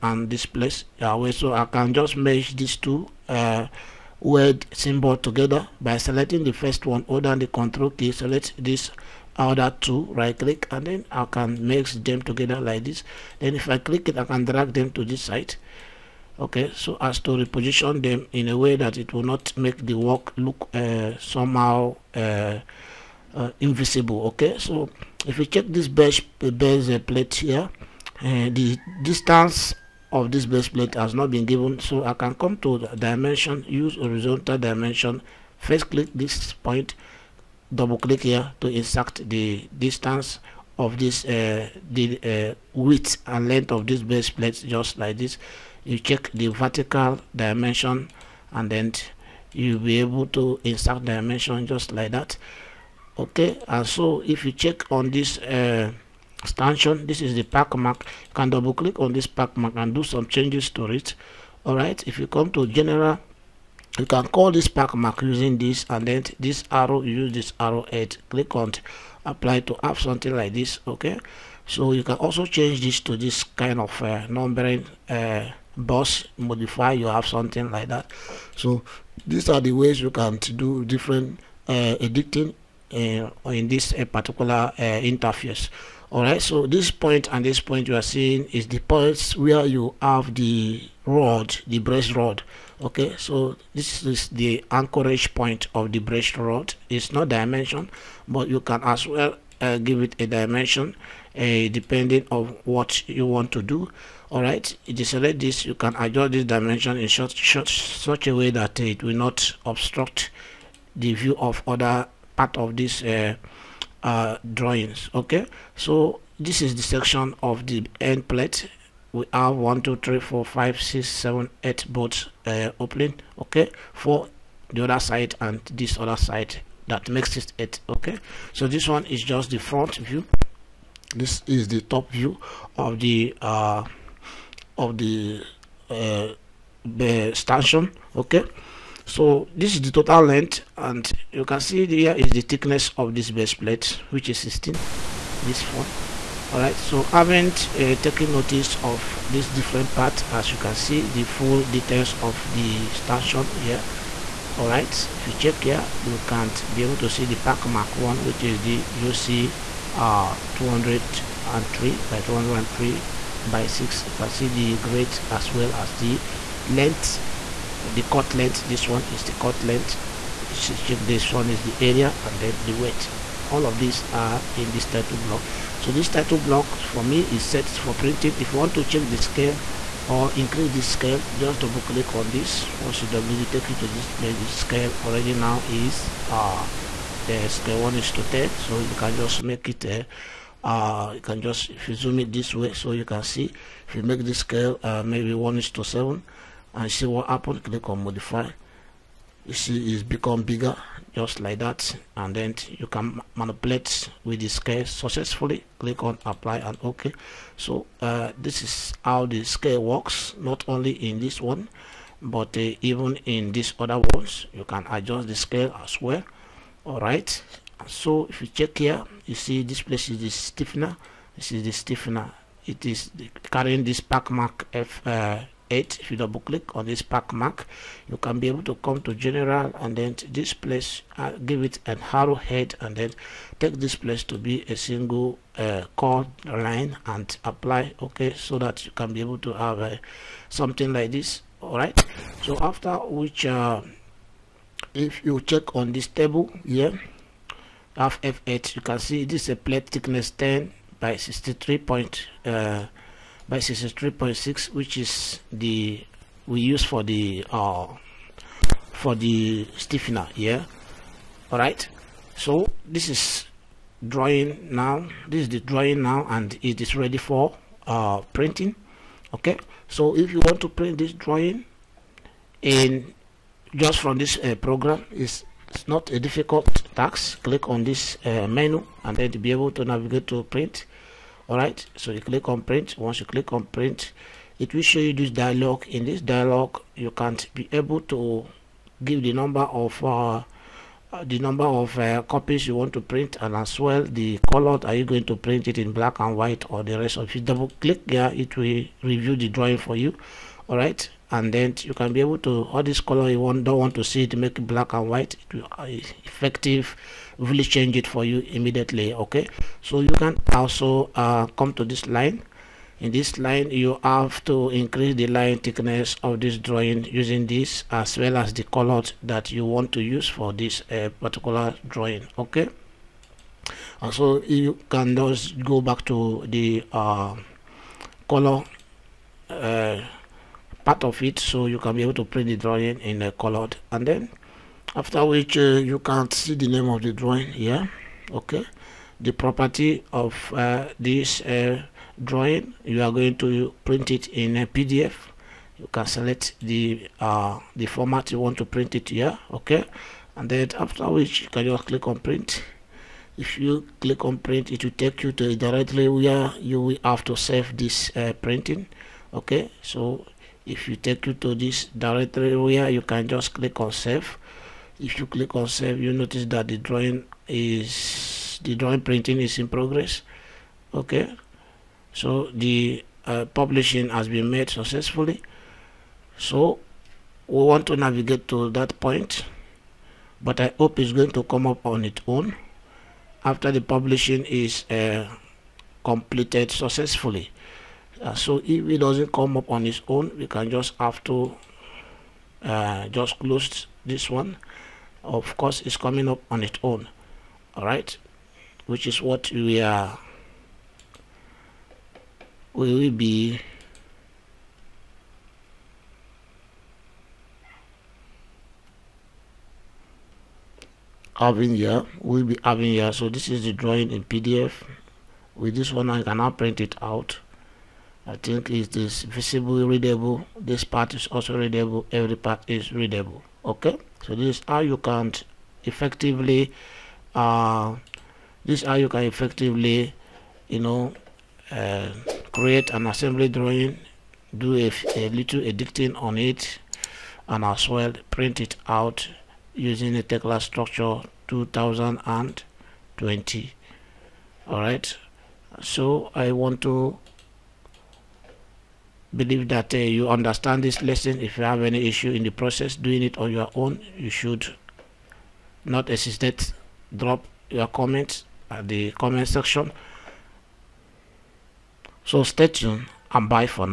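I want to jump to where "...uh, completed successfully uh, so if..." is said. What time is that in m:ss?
6:24.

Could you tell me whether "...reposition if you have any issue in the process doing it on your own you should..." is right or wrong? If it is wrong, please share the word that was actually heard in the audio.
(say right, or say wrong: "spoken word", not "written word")
wrong: "lesson", not "reposition".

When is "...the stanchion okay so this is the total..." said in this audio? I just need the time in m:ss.
2:16.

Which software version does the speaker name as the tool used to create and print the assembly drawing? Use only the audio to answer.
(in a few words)
Tekla Structures 2020.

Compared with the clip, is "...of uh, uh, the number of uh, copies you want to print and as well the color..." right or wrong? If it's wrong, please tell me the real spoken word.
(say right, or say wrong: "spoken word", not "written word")
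right.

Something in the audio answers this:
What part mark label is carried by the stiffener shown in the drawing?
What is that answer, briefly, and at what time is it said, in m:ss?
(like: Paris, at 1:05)
F8, at 3:44.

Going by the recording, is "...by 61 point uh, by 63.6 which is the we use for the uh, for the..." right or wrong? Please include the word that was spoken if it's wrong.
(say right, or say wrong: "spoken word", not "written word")
wrong: "63", not "61".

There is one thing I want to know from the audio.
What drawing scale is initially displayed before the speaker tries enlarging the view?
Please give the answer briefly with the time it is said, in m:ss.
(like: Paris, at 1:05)
1:10, at 3:07.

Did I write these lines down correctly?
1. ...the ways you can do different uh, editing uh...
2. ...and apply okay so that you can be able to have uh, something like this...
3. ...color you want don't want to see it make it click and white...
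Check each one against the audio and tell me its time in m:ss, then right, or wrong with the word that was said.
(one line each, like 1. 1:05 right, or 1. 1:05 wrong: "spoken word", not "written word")
1. 1:19 right
2. 3:57 right
3. 5:02 wrong: "black", not "click".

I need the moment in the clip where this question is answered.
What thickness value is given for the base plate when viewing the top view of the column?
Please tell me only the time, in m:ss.
2:24.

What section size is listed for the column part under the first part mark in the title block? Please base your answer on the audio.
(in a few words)
UC 203 by 203 by 6.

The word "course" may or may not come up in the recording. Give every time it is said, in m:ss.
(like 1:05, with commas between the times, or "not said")
6:35.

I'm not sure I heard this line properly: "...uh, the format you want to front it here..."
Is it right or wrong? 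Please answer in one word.
wrong.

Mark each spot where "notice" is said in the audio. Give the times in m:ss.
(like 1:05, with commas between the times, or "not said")
2:28, 6:06.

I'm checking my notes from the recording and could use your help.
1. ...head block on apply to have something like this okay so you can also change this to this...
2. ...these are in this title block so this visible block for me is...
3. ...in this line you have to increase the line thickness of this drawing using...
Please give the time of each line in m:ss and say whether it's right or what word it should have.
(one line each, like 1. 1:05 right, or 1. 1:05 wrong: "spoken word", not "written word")
1. 1:07 wrong: "click", not "block"
2. 2:53 wrong: "title", not "visible"
3. 5:12 right.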